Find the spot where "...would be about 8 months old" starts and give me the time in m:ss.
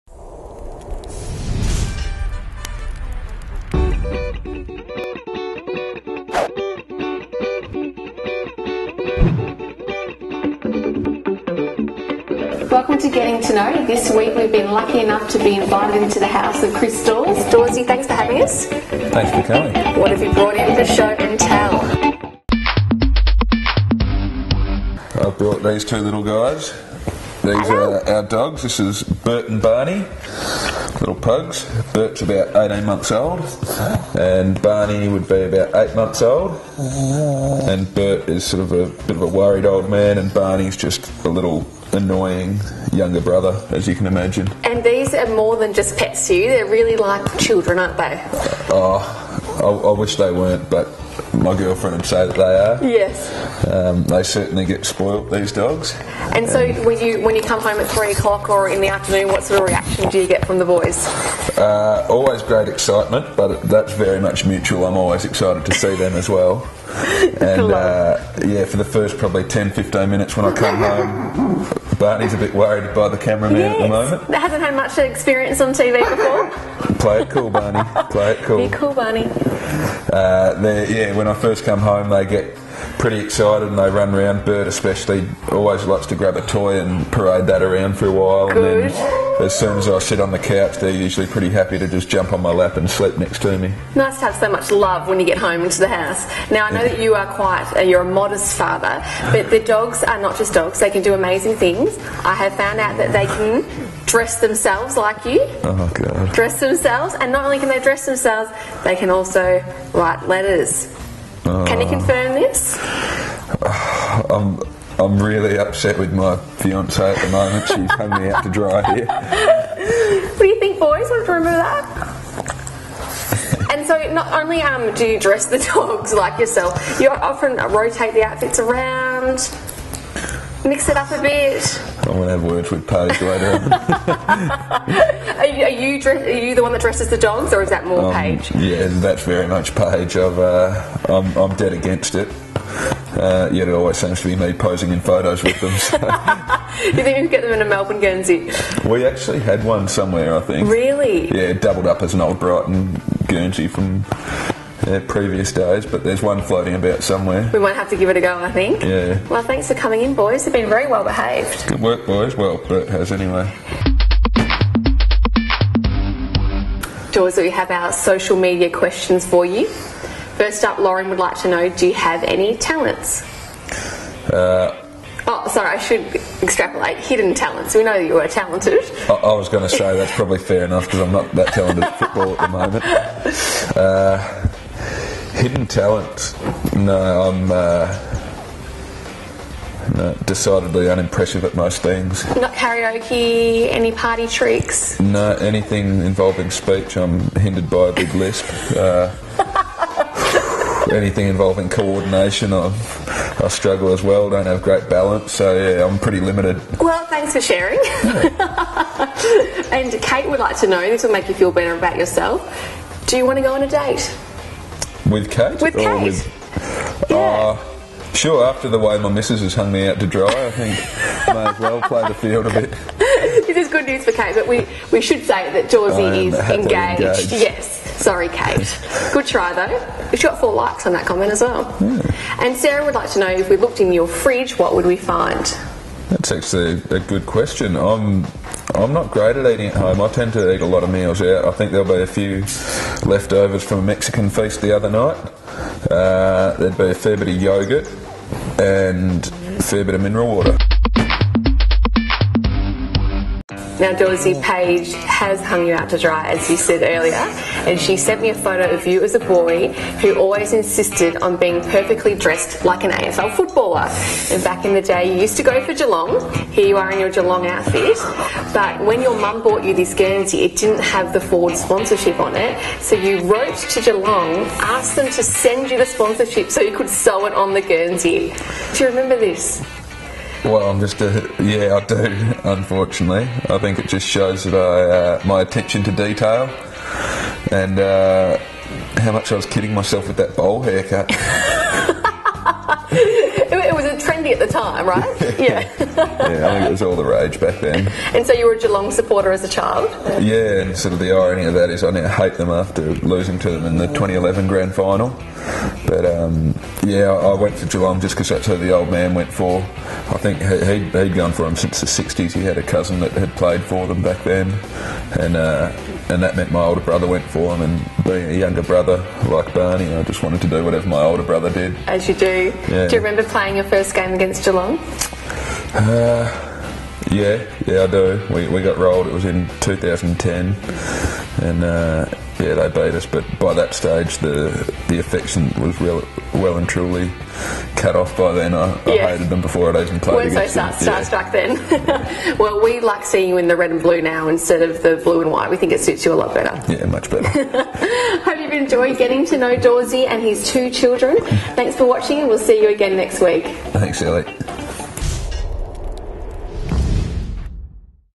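0:35.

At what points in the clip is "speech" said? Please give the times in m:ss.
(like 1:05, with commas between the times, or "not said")
3:16.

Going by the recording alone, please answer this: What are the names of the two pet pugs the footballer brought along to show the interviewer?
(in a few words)
Bert and Barney.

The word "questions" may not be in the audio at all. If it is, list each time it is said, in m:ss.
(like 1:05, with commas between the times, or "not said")
2:48, 3:57.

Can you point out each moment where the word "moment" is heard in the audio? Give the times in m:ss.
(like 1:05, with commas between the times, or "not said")
1:13, 1:57, 3:02.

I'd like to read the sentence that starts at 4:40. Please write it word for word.
Well, I'm just a yeah, I do.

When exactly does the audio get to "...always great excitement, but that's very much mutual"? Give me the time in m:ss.
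1:02.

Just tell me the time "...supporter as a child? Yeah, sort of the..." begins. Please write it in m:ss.
4:58.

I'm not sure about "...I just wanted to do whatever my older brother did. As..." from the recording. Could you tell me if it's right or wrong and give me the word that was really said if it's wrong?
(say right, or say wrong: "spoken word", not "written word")
right.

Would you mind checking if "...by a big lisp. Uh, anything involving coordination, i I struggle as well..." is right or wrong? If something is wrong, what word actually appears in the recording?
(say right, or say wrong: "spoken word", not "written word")
right.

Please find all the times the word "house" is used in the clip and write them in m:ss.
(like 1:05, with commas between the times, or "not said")
0:16, 1:35.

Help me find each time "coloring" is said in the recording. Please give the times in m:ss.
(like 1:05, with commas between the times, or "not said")
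not said.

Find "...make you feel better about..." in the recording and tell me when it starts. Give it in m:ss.
3:31.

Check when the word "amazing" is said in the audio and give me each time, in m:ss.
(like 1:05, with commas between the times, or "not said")
1:41.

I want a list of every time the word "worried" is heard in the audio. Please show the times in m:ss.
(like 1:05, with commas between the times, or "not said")
0:39, 1:12.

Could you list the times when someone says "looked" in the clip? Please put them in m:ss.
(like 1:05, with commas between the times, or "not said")
3:53.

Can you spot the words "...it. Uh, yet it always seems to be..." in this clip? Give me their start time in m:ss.
2:22.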